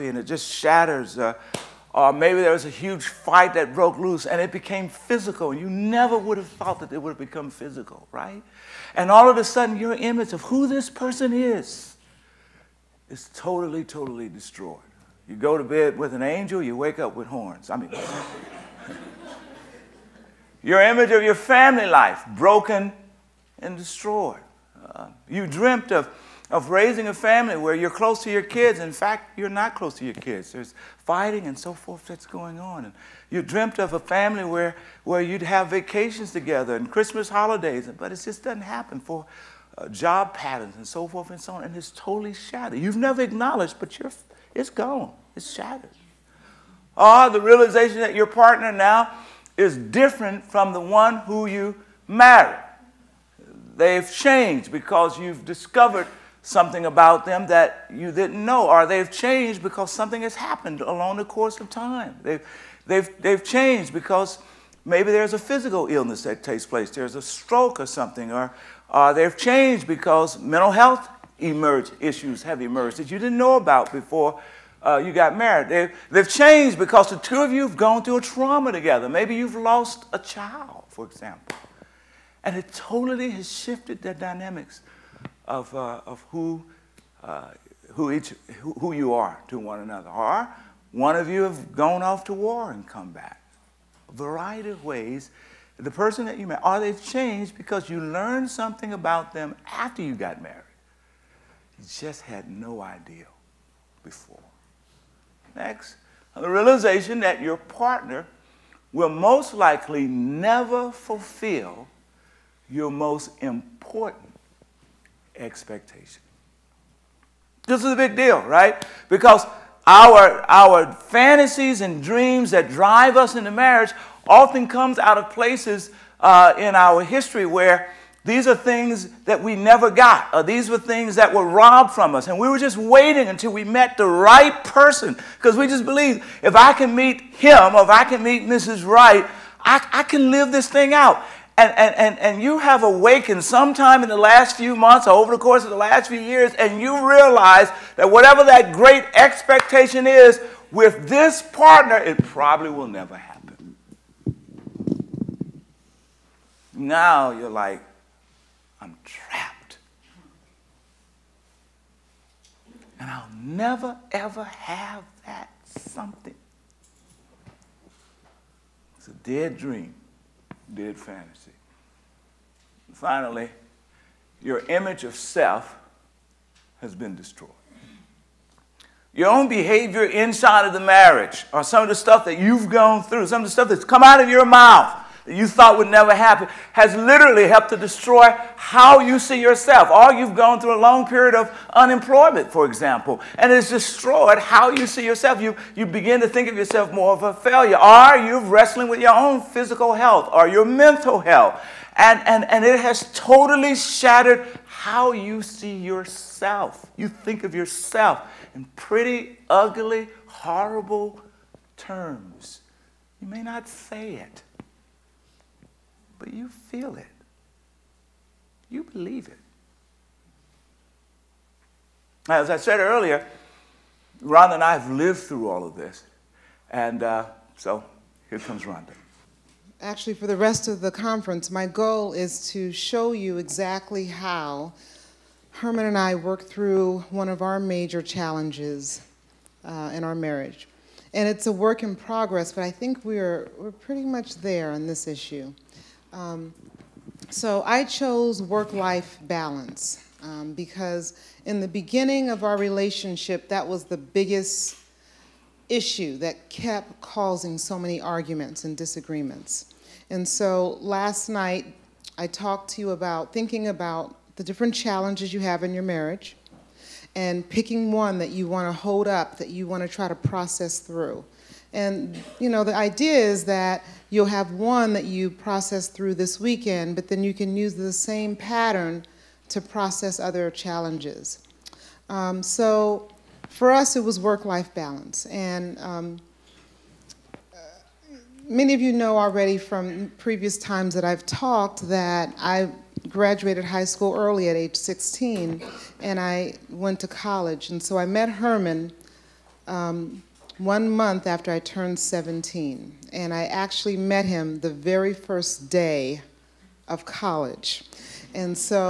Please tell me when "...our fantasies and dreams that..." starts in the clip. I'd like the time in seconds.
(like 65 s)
120 s.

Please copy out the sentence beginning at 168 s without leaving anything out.
It's a dead dream, dead fantasy.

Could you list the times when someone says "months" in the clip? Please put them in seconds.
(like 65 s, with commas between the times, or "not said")
144 s, 300 s.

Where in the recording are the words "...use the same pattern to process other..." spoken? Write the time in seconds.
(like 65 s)
277 s.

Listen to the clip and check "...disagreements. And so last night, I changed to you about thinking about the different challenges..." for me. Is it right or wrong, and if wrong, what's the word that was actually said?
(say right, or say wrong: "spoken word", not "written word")
wrong: "talked", not "changed".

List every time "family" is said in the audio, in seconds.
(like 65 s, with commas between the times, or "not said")
21 s, 27 s, 33 s.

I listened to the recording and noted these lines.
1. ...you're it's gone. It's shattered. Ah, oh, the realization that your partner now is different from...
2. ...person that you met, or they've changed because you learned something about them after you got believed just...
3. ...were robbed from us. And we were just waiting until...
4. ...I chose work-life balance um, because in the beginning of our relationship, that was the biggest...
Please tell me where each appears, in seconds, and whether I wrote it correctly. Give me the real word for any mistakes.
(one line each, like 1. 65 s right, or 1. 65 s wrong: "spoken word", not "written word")
1. 43 s right
2. 95 s wrong: "married", not "believed"
3. 131 s right
4. 247 s right.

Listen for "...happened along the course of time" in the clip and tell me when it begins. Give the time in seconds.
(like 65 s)
60 s.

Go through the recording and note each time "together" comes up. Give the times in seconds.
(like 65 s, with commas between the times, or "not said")
36 s, 78 s.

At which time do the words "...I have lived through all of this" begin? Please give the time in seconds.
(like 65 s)
224 s.